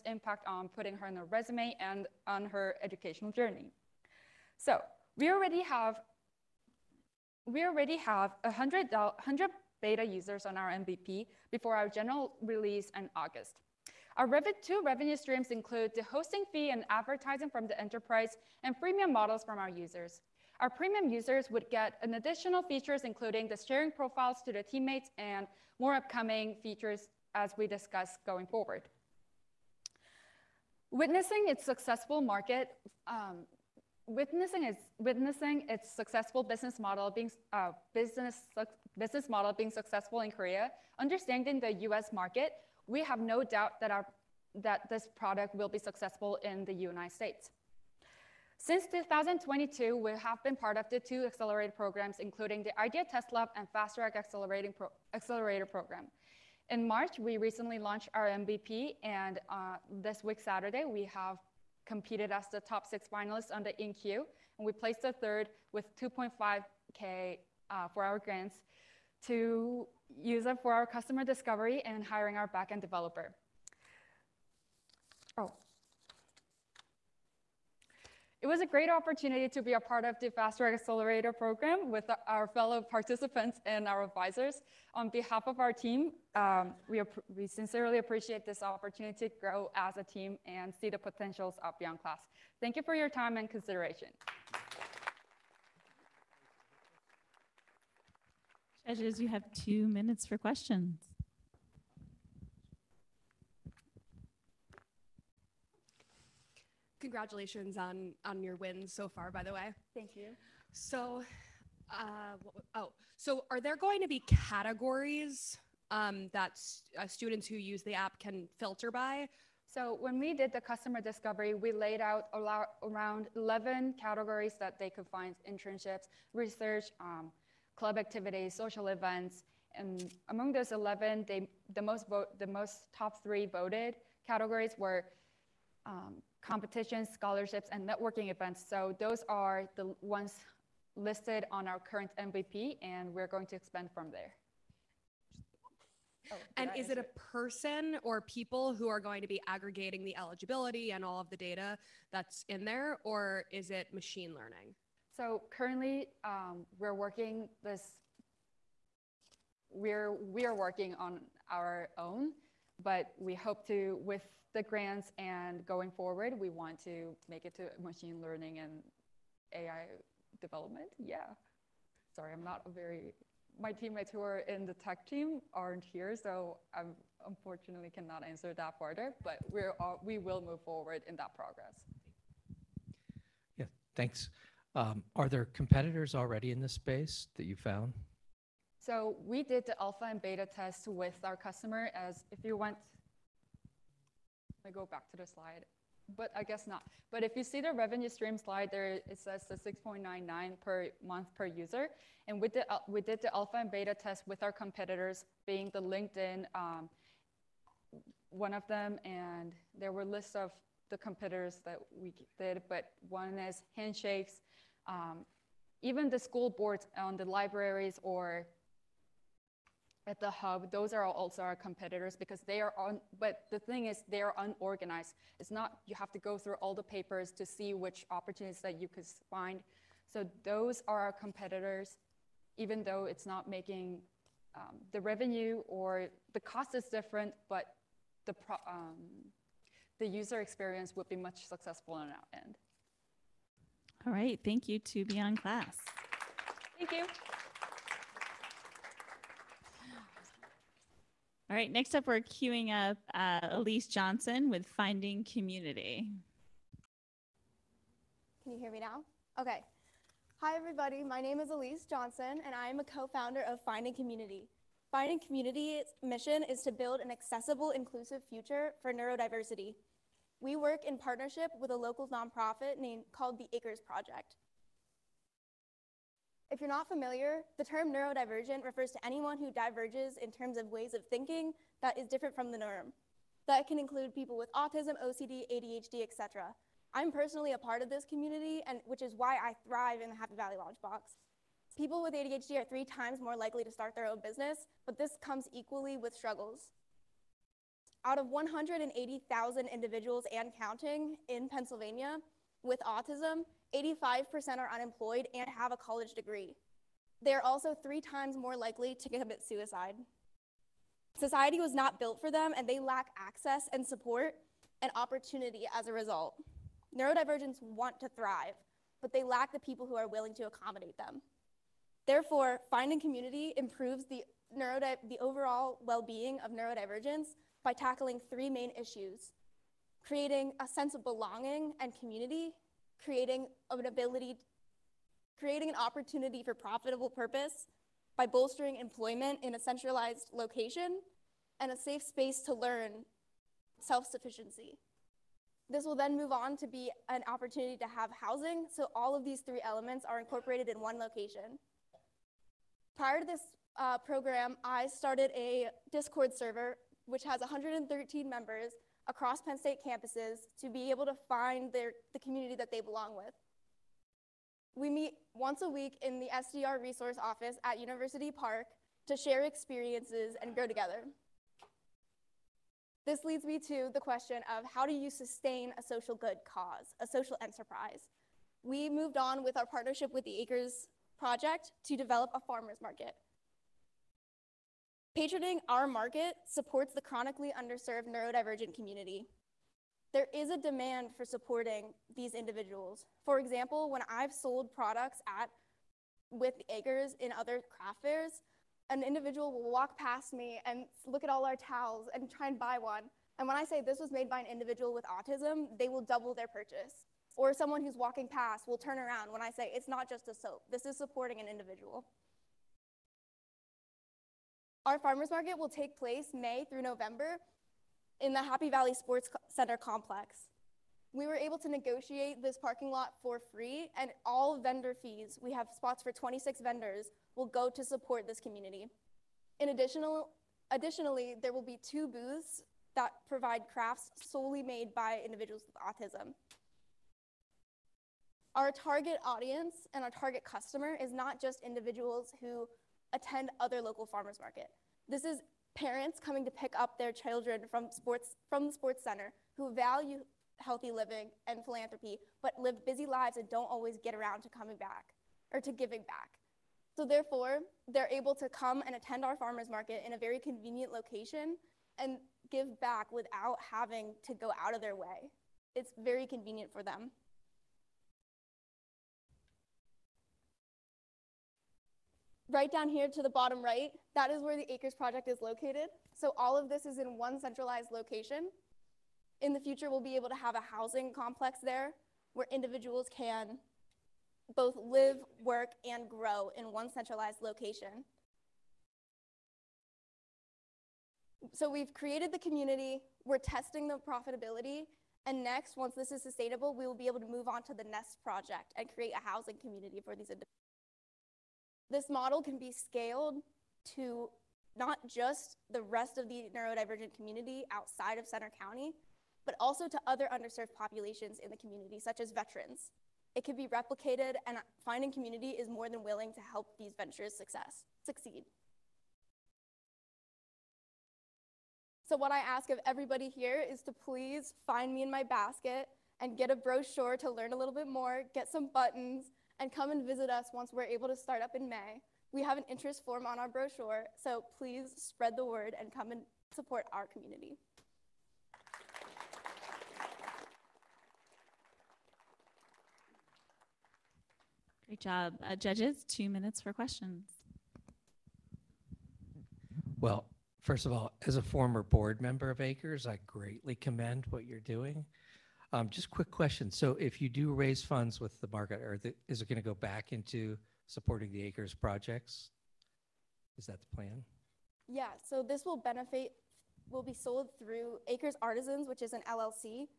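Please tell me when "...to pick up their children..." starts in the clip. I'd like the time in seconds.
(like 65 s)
446 s.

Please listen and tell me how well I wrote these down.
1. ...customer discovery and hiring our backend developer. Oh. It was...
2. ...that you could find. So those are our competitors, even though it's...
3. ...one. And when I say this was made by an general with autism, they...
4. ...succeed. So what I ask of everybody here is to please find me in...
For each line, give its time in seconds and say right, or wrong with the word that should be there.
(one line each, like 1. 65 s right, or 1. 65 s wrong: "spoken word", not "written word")
1. 70 s right
2. 228 s right
3. 402 s wrong: "individual", not "general"
4. 518 s right.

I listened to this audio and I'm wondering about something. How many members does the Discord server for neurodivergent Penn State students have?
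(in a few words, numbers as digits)
113.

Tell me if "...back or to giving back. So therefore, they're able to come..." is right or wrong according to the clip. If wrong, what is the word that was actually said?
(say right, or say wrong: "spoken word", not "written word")
right.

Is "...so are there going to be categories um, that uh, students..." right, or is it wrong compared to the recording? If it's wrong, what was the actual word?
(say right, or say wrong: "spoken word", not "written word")
right.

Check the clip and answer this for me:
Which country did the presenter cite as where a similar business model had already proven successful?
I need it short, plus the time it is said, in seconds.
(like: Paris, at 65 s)
Korea, at 40 s.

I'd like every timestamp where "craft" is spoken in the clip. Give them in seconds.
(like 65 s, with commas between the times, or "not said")
397 s, 433 s.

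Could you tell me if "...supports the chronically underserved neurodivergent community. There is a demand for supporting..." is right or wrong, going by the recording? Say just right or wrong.
right.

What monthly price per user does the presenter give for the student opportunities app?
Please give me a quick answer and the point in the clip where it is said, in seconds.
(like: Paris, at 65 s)
$6.99, at 199 s.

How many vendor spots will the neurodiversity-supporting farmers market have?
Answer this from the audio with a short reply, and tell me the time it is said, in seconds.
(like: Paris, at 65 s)
26, at 426 s.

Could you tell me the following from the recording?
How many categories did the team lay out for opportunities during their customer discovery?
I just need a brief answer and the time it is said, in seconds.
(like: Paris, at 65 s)
11, at 123 s.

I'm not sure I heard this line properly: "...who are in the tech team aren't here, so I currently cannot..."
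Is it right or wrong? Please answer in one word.
wrong.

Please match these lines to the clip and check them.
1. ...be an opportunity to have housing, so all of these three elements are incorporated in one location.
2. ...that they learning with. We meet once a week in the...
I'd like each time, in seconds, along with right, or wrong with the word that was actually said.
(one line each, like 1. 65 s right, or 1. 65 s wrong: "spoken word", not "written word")
1. 346 s right
2. 362 s wrong: "belong", not "learning".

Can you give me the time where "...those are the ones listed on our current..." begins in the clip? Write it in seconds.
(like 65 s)
138 s.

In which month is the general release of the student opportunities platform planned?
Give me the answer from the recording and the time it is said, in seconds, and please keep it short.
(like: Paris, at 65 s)
August, at 13 s.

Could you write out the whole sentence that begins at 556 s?
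So if you do raise funds with the market, or the, is it going to go back into supporting the acres projects?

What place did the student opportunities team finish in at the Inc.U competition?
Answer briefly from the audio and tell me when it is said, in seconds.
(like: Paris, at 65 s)
Third, at 65 s.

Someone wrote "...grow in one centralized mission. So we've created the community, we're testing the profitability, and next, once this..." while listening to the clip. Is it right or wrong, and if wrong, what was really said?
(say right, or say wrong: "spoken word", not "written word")
wrong: "location", not "mission".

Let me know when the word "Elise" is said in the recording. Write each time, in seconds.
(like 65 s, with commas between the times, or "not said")
253 s, 261 s.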